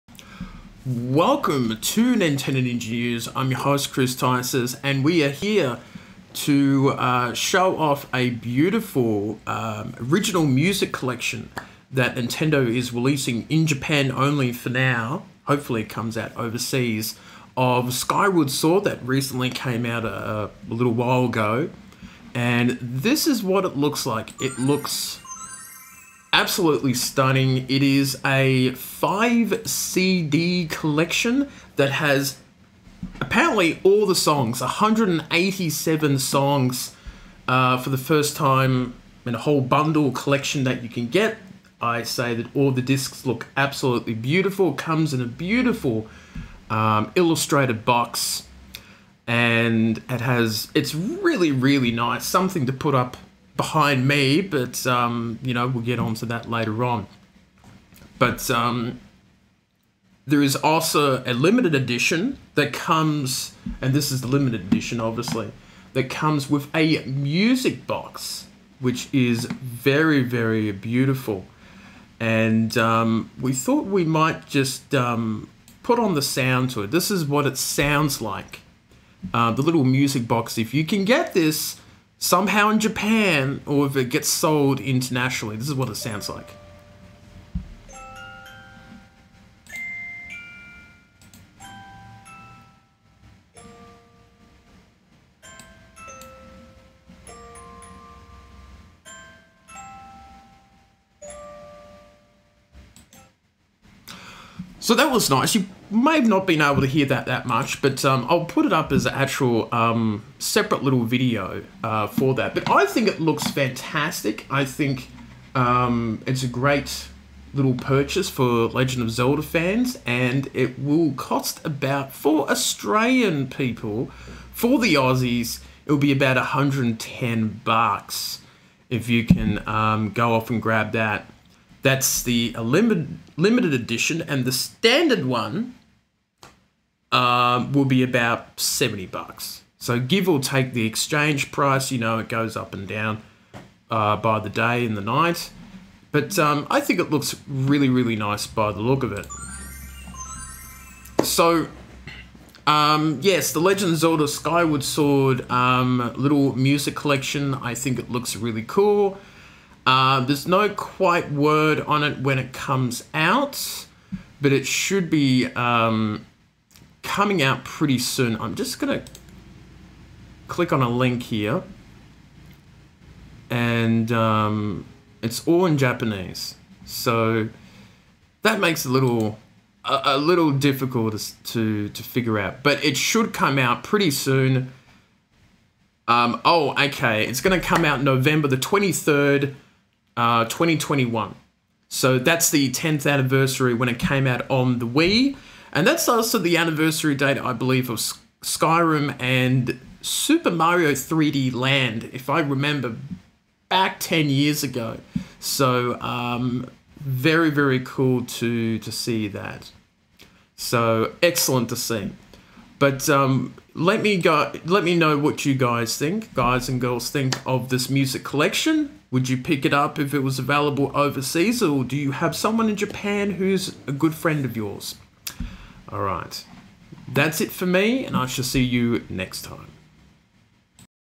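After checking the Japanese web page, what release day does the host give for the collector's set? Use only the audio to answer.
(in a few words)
November 23.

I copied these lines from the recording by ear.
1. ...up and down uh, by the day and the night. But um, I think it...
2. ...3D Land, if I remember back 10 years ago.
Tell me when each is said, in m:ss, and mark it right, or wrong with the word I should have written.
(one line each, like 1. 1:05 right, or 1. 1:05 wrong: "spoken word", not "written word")
1. 2:22 right
2. 3:20 right.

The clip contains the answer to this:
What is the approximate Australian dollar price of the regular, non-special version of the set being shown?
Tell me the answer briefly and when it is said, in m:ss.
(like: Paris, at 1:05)
$70, at 2:18.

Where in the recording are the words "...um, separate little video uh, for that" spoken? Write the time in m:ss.
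1:49.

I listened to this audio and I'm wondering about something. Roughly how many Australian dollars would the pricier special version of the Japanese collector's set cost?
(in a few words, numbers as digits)
$110.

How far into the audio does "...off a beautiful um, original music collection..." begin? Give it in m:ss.
0:07.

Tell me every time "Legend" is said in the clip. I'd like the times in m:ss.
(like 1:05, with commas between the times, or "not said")
1:58, 2:33.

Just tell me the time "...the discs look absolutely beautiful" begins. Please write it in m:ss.
0:42.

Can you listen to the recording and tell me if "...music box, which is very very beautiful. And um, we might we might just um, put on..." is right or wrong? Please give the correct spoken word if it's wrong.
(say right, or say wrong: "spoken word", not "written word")
wrong: "thought", not "might".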